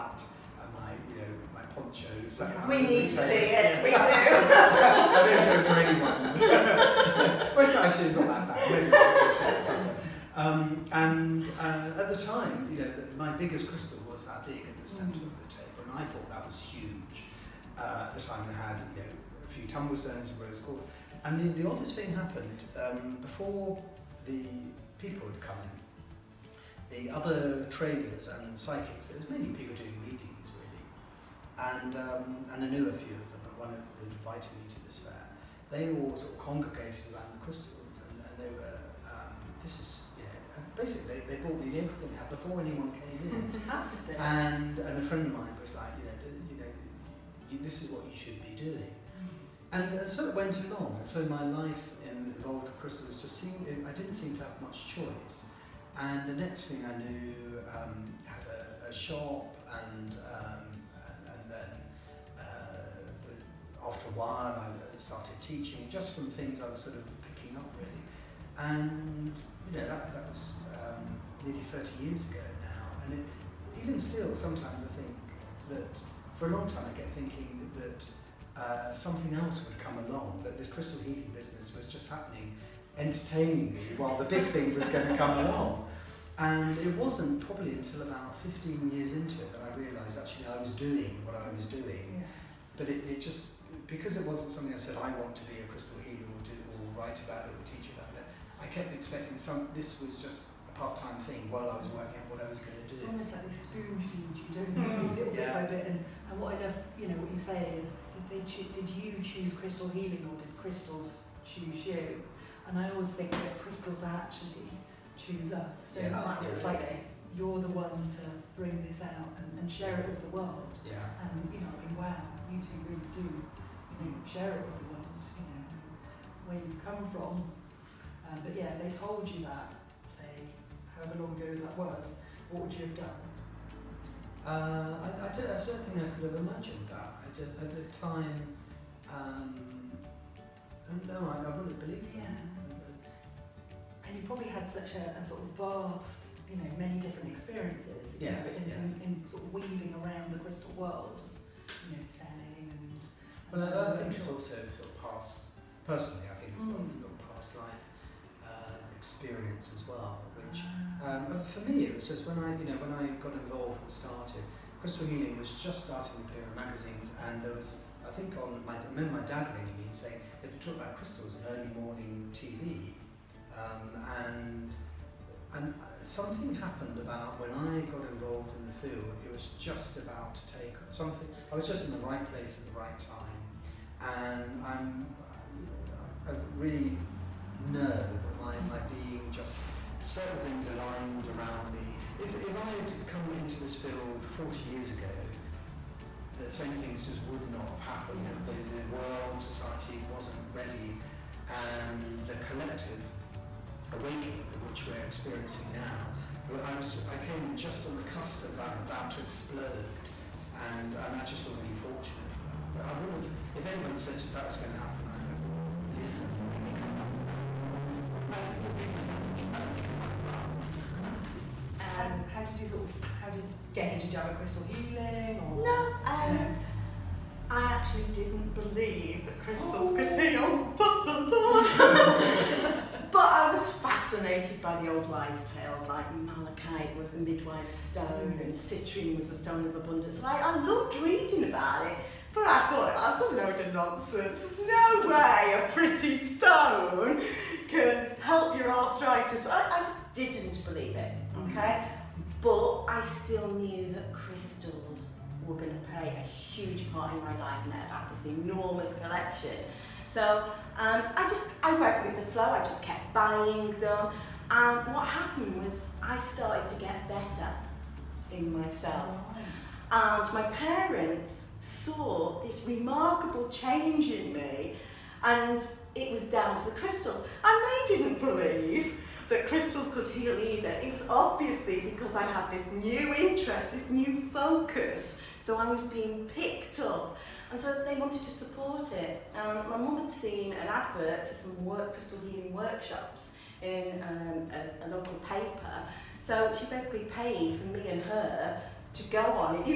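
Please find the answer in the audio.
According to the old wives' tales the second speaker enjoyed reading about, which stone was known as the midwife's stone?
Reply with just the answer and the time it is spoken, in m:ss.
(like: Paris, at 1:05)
malachite, at 3:56.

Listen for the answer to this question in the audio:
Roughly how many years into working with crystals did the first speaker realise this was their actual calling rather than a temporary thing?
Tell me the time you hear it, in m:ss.
1:28.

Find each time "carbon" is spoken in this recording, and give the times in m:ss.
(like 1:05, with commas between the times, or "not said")
not said.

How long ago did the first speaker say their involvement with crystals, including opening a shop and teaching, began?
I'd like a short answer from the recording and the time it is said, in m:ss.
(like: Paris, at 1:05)
nearly 30 years, at 1:11.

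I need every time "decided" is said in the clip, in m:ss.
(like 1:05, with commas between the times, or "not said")
not said.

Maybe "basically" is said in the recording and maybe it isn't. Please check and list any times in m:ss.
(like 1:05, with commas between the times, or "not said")
0:40, 4:56.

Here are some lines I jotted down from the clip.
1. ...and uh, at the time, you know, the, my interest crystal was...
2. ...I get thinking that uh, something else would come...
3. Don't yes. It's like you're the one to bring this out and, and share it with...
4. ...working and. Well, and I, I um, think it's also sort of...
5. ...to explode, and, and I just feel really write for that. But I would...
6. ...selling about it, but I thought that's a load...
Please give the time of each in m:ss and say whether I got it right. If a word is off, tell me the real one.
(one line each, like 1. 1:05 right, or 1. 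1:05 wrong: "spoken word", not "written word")
1. 0:10 wrong: "biggest", not "interest"
2. 1:16 right
3. 1:55 right
4. 2:32 wrong: "selling", not "working"
5. 3:29 wrong: "fortunate", not "write"
6. 4:00 wrong: "reading", not "selling".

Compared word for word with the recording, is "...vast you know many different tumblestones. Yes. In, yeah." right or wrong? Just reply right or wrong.
wrong.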